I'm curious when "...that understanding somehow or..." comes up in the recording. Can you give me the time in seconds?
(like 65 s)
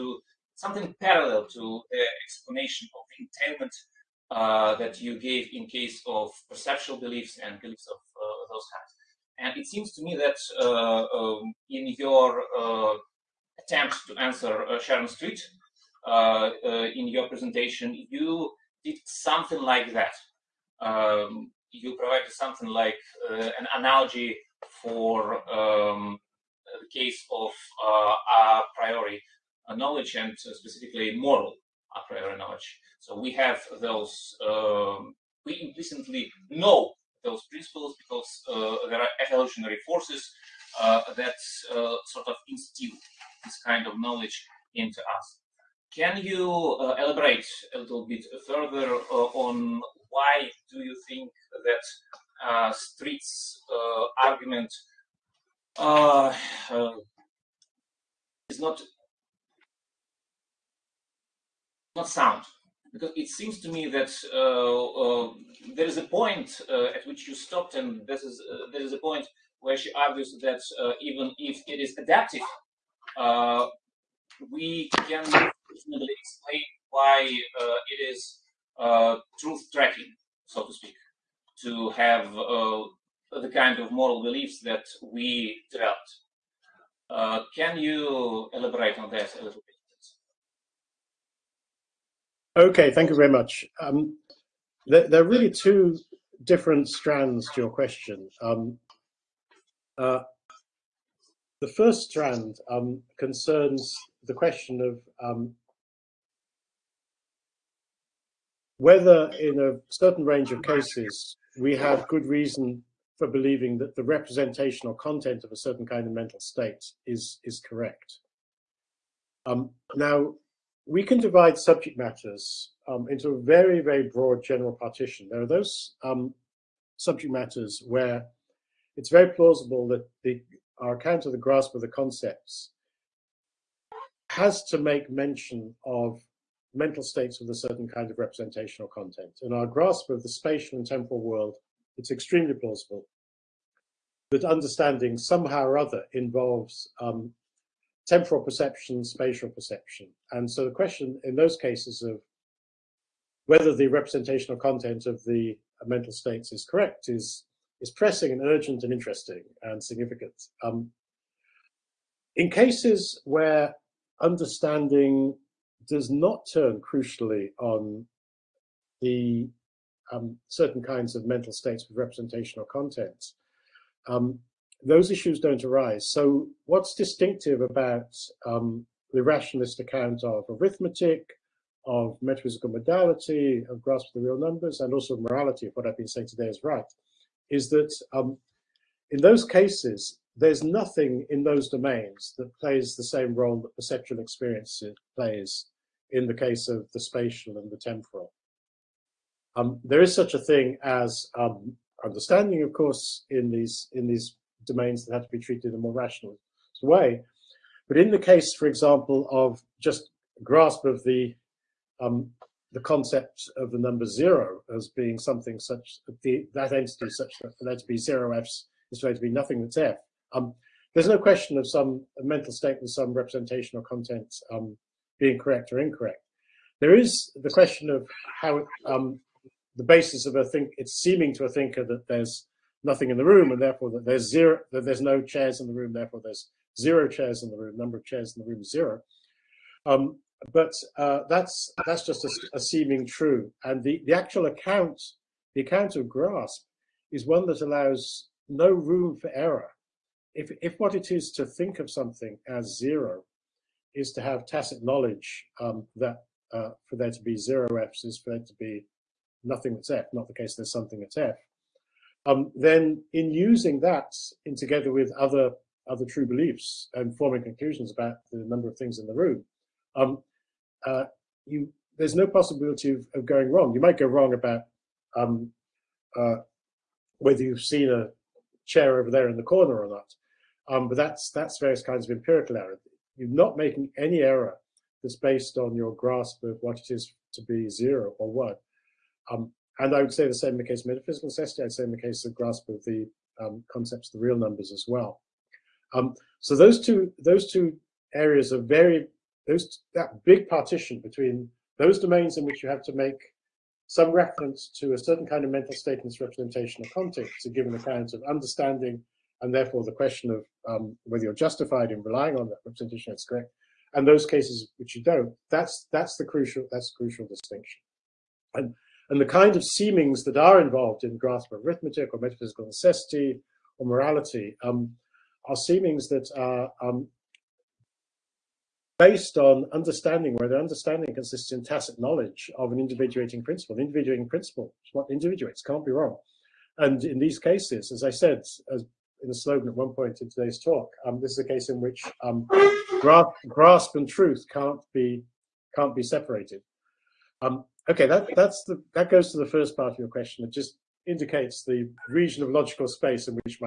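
144 s.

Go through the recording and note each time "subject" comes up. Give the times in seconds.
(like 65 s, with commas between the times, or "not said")
121 s, 126 s.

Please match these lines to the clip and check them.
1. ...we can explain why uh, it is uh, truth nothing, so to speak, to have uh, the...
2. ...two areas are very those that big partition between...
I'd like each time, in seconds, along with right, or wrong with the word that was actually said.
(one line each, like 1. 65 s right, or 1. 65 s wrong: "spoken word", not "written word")
1. 74 s wrong: "tracking", not "nothing"
2. 297 s right.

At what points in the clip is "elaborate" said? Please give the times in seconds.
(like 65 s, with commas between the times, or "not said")
46 s, 88 s.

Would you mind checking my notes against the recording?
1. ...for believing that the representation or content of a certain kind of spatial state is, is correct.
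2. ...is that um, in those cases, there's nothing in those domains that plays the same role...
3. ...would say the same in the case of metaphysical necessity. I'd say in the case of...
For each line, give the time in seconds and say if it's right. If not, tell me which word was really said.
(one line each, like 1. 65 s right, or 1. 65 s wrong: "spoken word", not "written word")
1. 113 s wrong: "mental", not "spatial"
2. 187 s right
3. 290 s right.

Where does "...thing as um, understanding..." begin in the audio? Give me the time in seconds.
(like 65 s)
200 s.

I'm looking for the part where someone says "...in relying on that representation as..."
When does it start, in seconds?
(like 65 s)
311 s.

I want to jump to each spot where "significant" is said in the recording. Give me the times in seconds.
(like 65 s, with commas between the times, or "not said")
159 s.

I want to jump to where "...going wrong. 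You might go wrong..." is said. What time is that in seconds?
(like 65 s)
273 s.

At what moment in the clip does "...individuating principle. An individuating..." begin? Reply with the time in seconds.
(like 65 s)
332 s.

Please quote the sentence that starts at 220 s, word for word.
Um, there's no question of some mental state with some representation or content um, being correct or incorrect.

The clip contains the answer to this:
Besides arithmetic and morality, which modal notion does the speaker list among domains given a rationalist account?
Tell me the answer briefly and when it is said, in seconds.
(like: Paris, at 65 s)
metaphysical modality, at 182 s.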